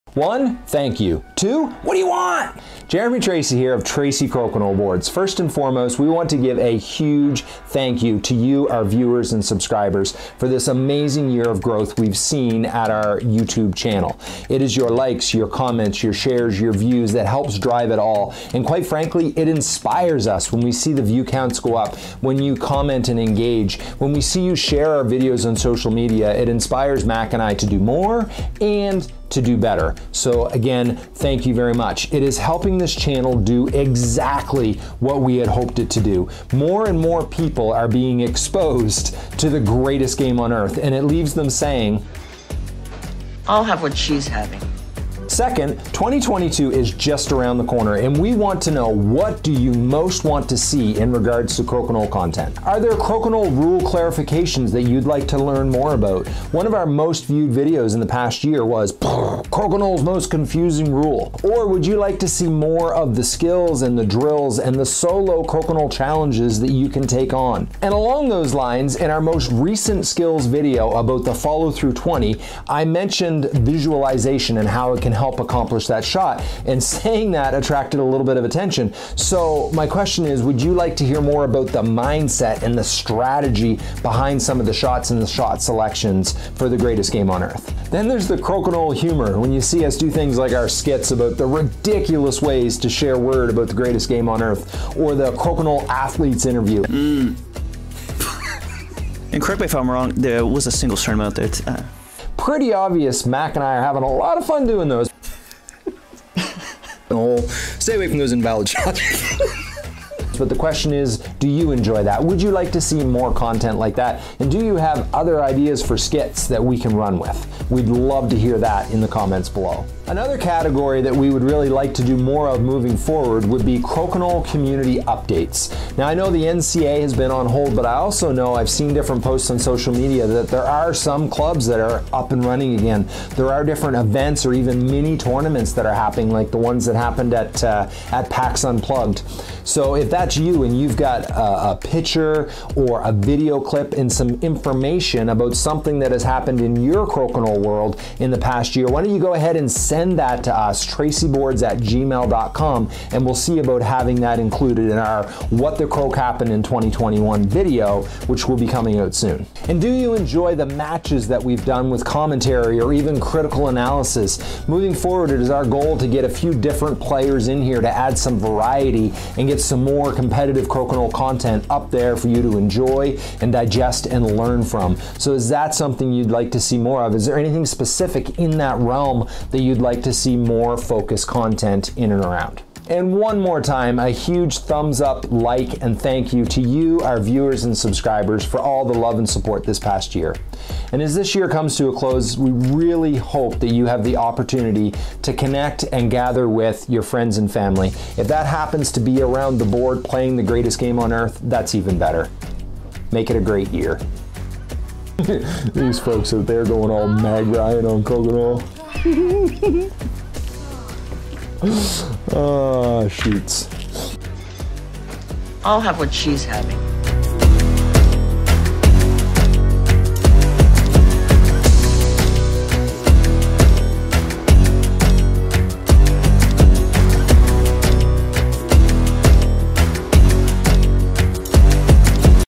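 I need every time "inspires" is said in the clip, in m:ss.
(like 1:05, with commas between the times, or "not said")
0:19, 0:26.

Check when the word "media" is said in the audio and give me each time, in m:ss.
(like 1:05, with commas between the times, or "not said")
0:25, 2:09.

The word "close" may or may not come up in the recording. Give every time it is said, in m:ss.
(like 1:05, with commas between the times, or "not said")
3:11.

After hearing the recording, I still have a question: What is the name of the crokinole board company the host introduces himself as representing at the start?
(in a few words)
Tracey Crokinole Boards.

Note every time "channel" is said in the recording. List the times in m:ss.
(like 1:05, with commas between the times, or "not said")
0:13, 0:32.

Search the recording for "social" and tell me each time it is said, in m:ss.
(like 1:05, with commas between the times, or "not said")
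0:25, 2:09.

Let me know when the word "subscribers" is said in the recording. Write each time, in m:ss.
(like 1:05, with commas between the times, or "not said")
0:09, 3:07.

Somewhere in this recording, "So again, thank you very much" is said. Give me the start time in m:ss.
0:30.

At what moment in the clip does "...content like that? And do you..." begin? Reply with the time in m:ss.
1:53.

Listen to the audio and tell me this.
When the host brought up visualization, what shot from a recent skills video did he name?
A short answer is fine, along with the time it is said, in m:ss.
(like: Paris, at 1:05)
follow through 20, at 1:11.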